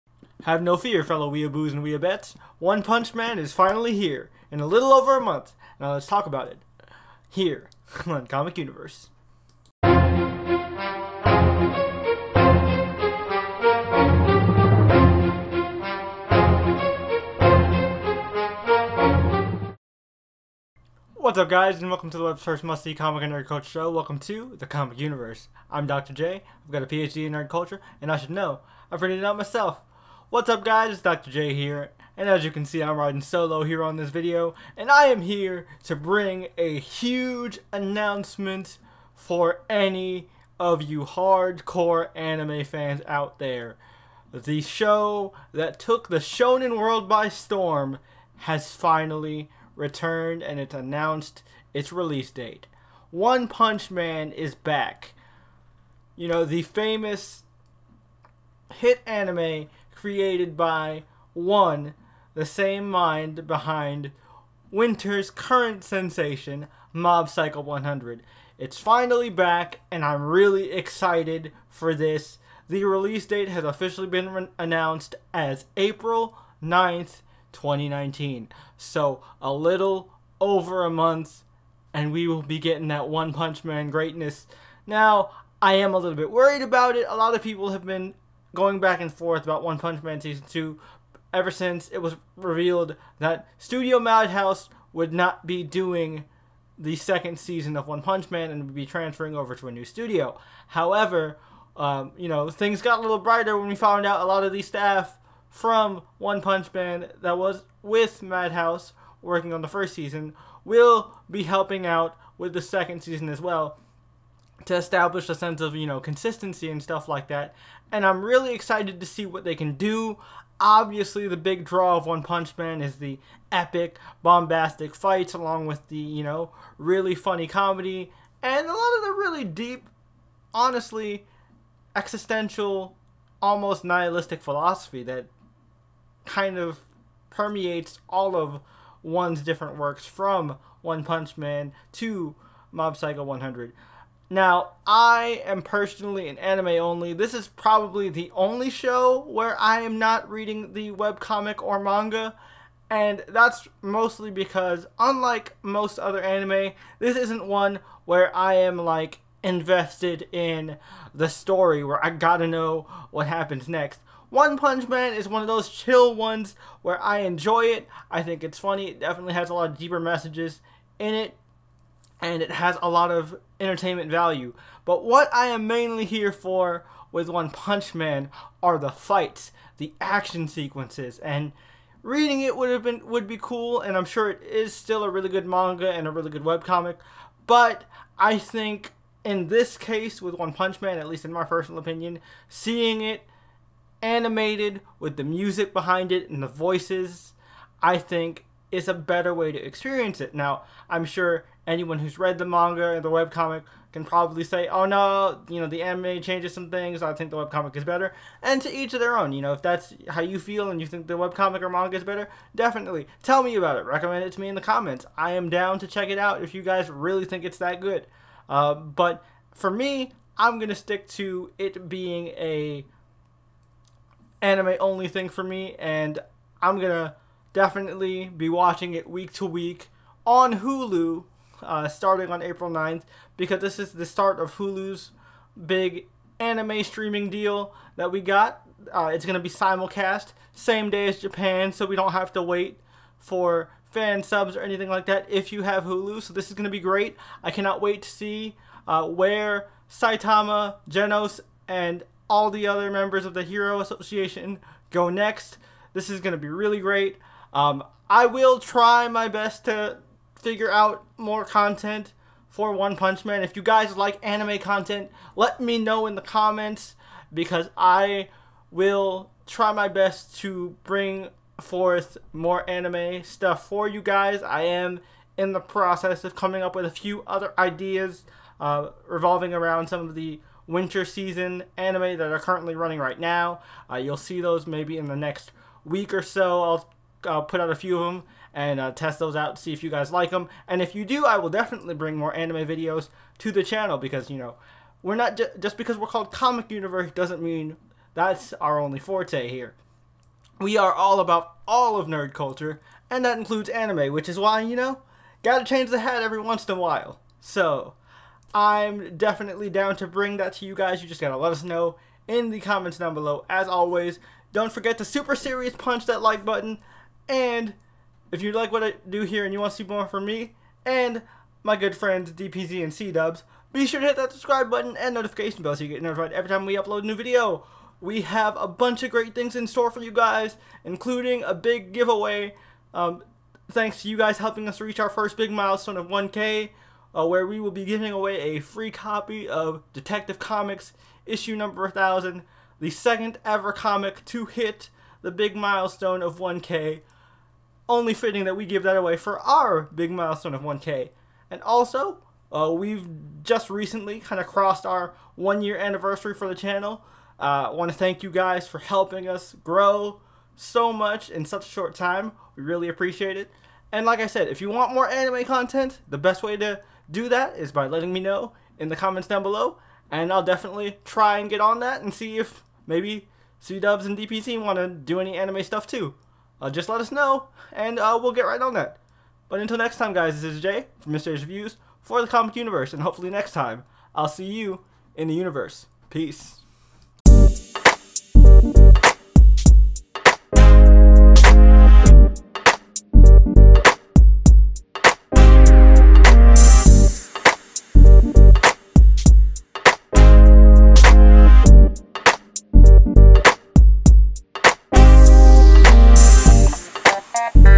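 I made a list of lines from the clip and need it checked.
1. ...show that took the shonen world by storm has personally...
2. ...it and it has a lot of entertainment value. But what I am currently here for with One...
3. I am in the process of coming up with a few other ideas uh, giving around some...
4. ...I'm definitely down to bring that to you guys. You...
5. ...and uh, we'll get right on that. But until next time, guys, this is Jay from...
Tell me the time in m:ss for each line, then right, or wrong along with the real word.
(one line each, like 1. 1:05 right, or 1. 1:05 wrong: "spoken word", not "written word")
1. 0:44 wrong: "finally", not "personally"
2. 2:51 wrong: "mainly", not "currently"
3. 4:34 wrong: "revolving", not "giving"
4. 5:08 right
5. 6:17 right.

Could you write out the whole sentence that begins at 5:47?
Only fitting that we give that away for our big milestone of 1K.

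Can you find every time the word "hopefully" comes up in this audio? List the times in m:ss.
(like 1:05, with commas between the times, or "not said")
6:23.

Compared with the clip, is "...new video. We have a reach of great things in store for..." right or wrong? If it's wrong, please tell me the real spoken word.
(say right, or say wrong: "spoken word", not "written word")
wrong: "bunch", not "reach".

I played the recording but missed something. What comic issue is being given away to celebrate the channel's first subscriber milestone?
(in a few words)
Detective Comics #1000.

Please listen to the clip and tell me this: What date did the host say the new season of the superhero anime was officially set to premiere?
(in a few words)
April 9th, 2019.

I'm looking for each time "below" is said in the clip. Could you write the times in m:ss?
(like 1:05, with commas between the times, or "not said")
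5:13, 6:09.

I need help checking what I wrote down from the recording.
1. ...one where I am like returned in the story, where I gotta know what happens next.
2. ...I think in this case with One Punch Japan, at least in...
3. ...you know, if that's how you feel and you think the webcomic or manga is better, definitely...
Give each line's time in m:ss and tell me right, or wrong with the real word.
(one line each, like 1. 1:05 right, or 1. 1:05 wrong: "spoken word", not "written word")
1. 2:37 wrong: "invested", not "returned"
2. 3:08 wrong: "Man", not "Japan"
3. 3:29 right.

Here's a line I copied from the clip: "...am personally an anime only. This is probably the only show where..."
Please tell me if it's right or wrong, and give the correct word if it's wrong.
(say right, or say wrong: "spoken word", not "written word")
right.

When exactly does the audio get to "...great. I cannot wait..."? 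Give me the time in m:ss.
4:06.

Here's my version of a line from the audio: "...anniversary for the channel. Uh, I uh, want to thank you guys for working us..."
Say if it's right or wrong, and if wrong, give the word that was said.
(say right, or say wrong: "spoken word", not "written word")
wrong: "helping", not "working".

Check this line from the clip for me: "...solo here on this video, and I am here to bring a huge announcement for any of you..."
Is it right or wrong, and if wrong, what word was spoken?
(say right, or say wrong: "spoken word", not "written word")
right.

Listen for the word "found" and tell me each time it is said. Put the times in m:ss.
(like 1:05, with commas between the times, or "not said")
1:43.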